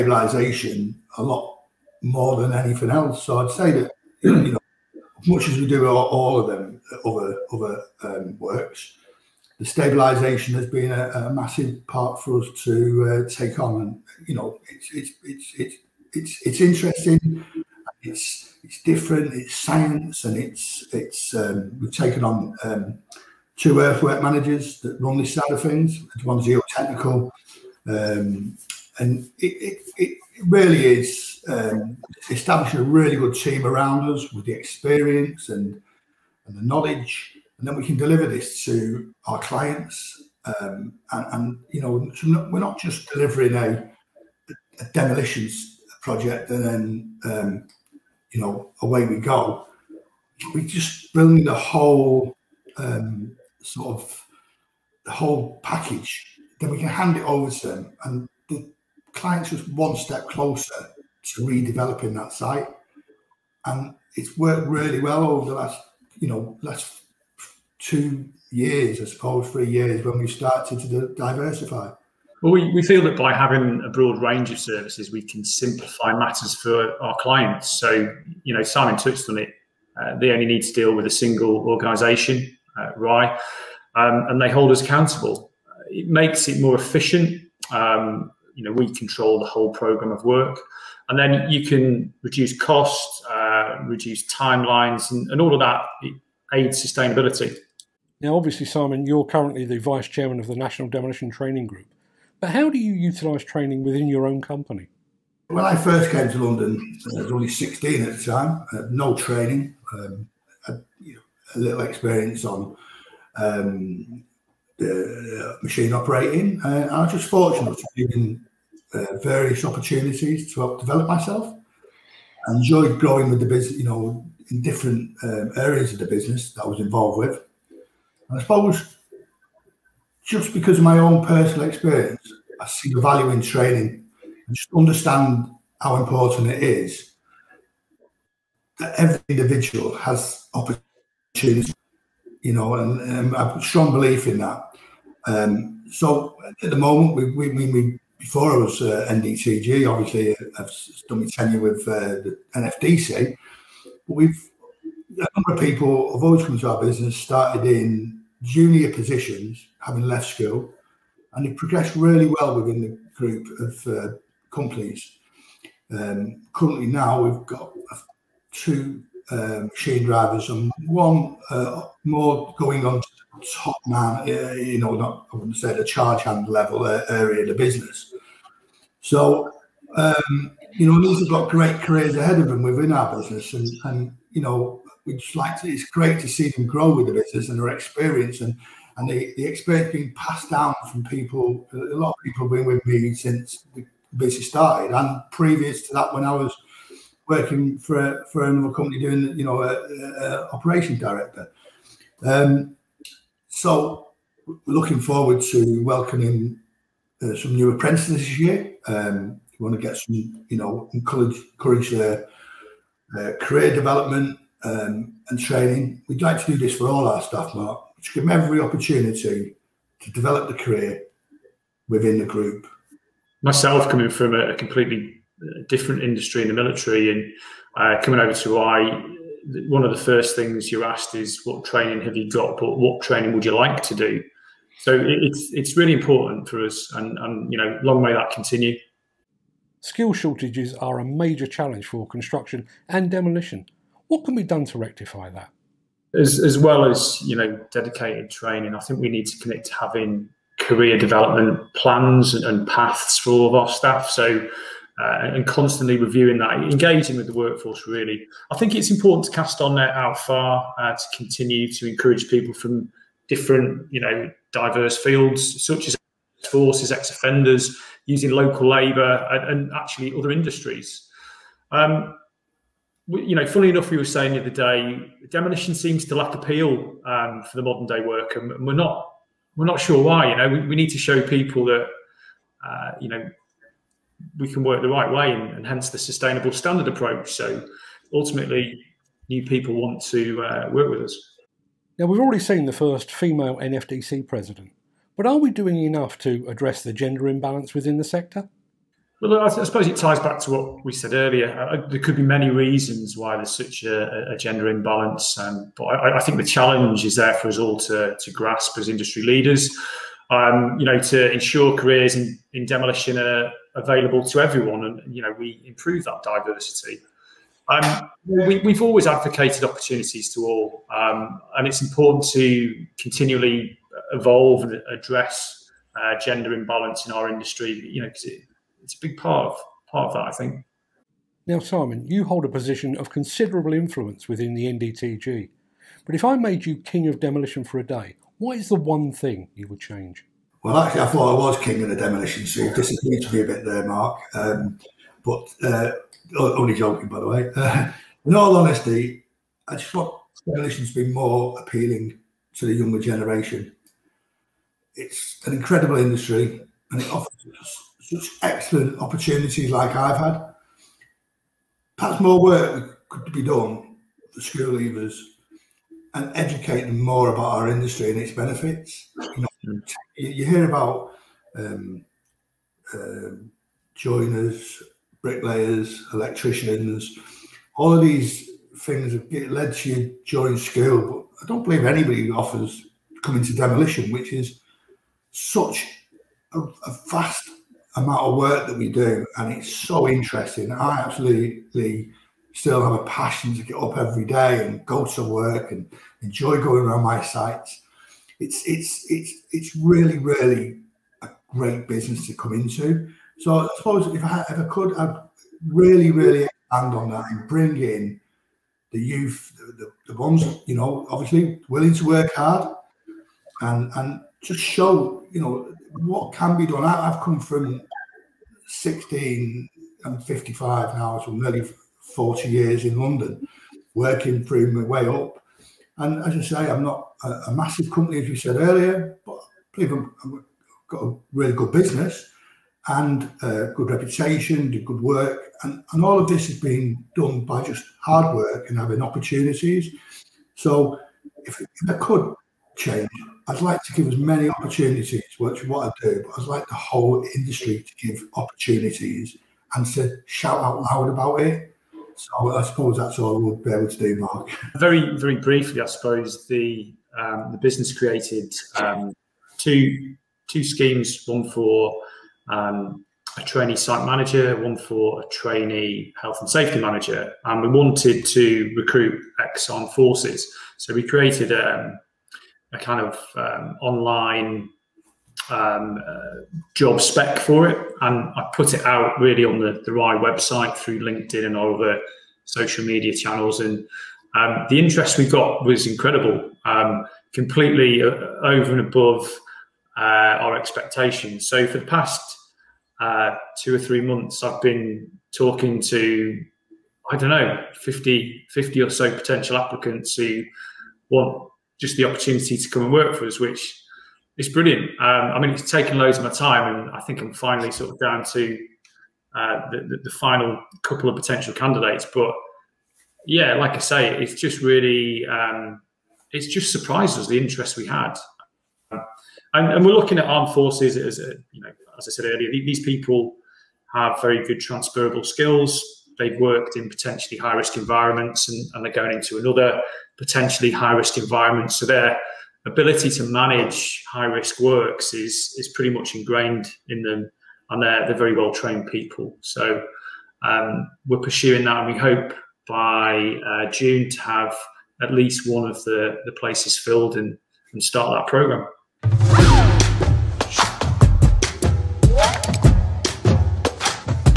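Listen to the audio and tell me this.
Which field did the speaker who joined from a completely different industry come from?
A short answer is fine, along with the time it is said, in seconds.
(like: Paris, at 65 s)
the military, at 226 s.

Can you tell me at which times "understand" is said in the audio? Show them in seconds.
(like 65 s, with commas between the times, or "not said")
134 s.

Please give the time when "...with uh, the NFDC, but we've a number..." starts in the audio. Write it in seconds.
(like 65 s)
151 s.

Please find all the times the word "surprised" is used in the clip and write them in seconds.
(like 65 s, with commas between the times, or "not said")
516 s.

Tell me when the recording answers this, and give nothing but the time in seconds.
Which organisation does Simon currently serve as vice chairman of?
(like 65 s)
100 s.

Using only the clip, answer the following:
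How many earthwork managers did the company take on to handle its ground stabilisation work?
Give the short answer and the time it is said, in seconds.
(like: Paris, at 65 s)
2, at 23 s.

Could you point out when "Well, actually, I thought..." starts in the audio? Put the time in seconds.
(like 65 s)
340 s.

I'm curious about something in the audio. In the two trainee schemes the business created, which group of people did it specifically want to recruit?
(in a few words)
ex armed forces.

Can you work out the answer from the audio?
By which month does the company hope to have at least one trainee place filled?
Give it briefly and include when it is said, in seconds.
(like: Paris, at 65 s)
June, at 543 s.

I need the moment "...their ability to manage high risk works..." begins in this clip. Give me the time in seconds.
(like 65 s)
531 s.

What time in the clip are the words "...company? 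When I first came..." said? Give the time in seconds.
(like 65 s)
104 s.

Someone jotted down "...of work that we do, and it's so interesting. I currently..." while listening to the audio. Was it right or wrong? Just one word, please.
wrong.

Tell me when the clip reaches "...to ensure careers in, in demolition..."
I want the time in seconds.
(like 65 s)
310 s.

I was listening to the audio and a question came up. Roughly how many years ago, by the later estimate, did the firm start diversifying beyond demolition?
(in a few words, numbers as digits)
3.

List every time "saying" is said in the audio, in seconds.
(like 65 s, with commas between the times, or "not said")
274 s.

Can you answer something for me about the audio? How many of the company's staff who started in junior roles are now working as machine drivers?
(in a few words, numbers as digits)
2.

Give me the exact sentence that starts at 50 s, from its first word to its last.
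We just bring the whole um, sort of the whole package.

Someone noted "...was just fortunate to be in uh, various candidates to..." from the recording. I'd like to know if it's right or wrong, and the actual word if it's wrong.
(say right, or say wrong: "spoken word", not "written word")
wrong: "opportunities", not "candidates".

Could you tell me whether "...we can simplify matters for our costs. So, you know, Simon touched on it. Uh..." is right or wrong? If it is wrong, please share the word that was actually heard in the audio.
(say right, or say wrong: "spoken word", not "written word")
wrong: "clients", not "costs".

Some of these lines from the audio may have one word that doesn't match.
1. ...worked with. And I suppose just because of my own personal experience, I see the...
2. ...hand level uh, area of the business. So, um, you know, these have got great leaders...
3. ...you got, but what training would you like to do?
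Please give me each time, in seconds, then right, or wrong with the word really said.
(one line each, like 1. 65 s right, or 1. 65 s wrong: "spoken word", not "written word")
1. 126 s wrong: "involved", not "worked"
2. 176 s wrong: "careers", not "leaders"
3. 232 s right.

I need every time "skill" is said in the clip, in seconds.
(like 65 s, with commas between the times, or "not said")
239 s, 525 s.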